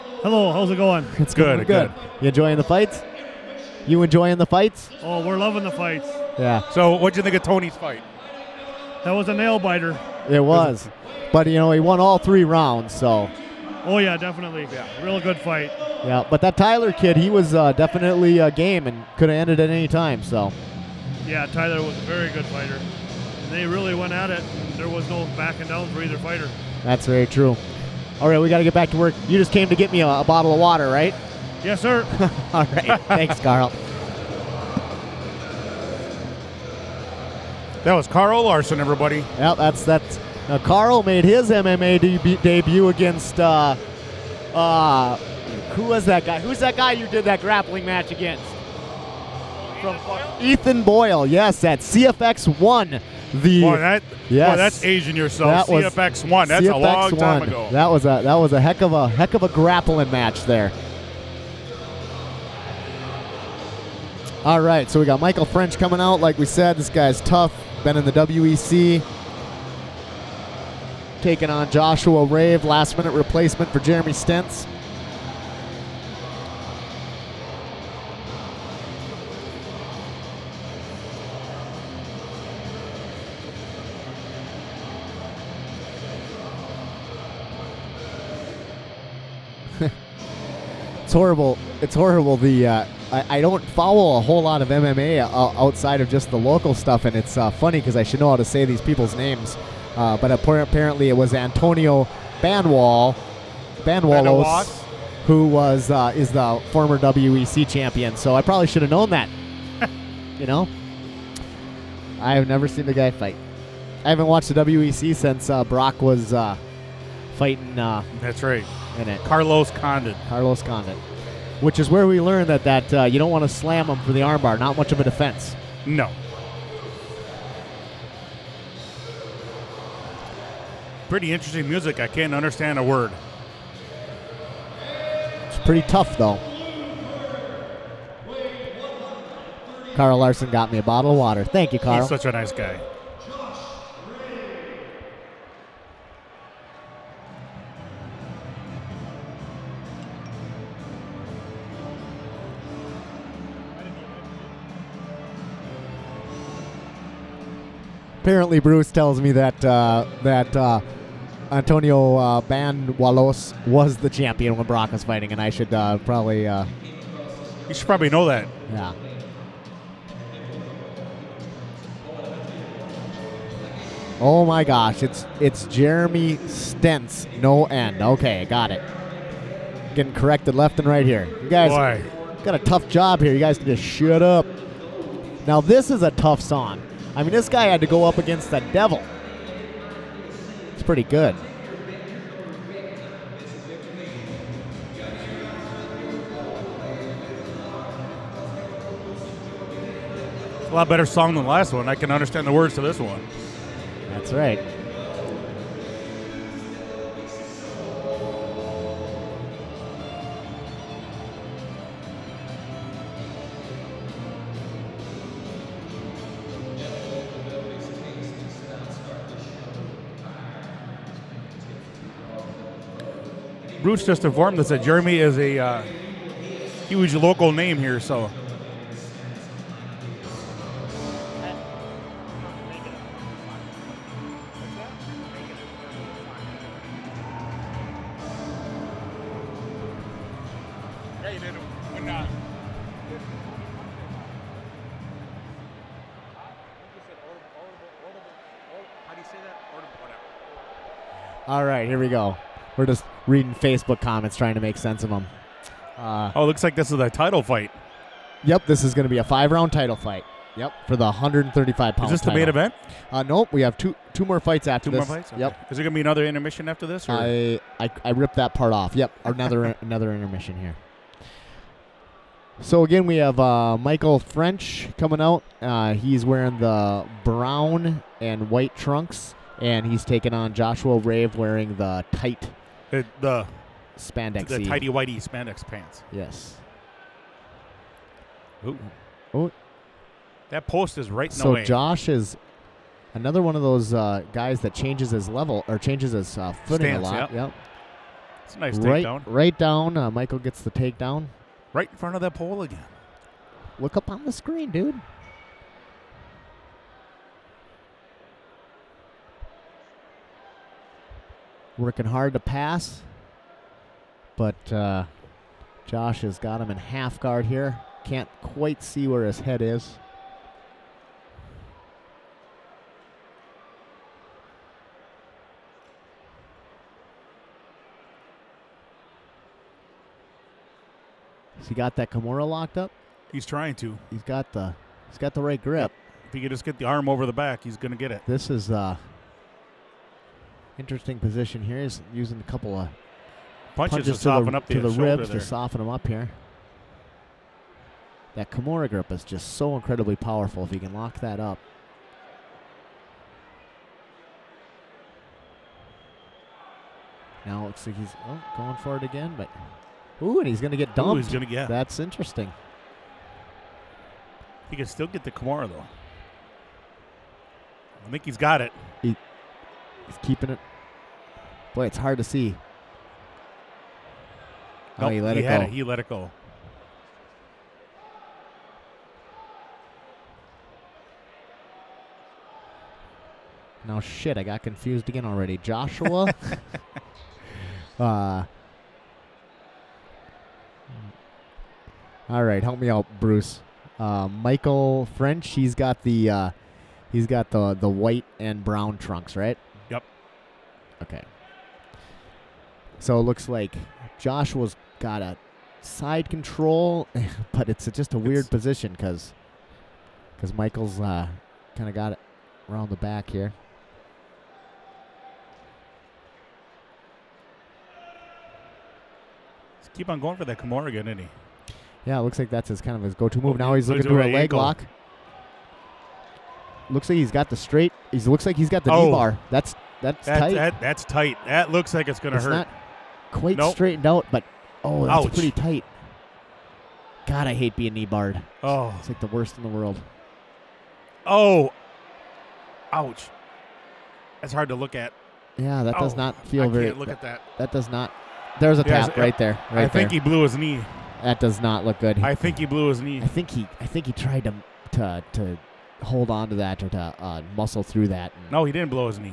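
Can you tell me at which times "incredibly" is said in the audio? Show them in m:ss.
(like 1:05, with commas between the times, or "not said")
5:49.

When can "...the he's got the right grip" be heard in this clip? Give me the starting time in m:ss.
5:34.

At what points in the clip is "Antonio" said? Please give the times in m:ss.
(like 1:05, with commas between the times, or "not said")
1:41, 2:41.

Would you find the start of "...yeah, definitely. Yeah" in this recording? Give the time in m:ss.
0:13.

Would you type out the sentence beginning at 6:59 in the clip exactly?
keep on going for that Kimura again, isn't he?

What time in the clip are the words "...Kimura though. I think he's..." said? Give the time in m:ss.
6:05.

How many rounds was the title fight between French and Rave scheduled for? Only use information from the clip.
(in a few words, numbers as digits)
5.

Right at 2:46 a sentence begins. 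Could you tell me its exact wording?
Uh, you should probably know that.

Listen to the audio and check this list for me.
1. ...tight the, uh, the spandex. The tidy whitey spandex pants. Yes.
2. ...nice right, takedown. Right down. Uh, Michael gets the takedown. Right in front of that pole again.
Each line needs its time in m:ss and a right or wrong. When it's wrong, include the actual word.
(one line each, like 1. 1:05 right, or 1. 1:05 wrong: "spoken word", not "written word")
1. 4:42 right
2. 4:58 right.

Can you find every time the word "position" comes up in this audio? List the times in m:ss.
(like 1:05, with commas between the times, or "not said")
5:41, 6:48.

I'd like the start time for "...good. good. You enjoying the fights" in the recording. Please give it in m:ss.
0:01.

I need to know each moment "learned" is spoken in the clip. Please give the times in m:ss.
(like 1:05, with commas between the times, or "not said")
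2:02.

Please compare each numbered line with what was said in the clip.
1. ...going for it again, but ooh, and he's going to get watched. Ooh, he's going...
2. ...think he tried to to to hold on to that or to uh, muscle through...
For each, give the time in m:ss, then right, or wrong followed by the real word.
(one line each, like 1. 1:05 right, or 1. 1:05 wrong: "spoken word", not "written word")
1. 5:58 wrong: "dumped", not "watched"
2. 7:33 right.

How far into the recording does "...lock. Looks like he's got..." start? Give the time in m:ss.
7:04.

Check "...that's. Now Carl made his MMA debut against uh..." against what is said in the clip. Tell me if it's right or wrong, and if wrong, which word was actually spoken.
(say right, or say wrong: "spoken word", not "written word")
right.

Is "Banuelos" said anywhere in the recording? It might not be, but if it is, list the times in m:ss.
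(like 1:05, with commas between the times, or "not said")
1:43, 2:42.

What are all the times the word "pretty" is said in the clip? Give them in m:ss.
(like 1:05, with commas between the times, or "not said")
2:11, 2:15, 3:10, 7:15.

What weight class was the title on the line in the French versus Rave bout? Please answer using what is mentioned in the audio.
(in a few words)
135 pounds.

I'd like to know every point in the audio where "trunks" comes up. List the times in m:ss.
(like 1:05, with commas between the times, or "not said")
4:38, 6:38.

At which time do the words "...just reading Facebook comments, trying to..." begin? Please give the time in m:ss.
4:12.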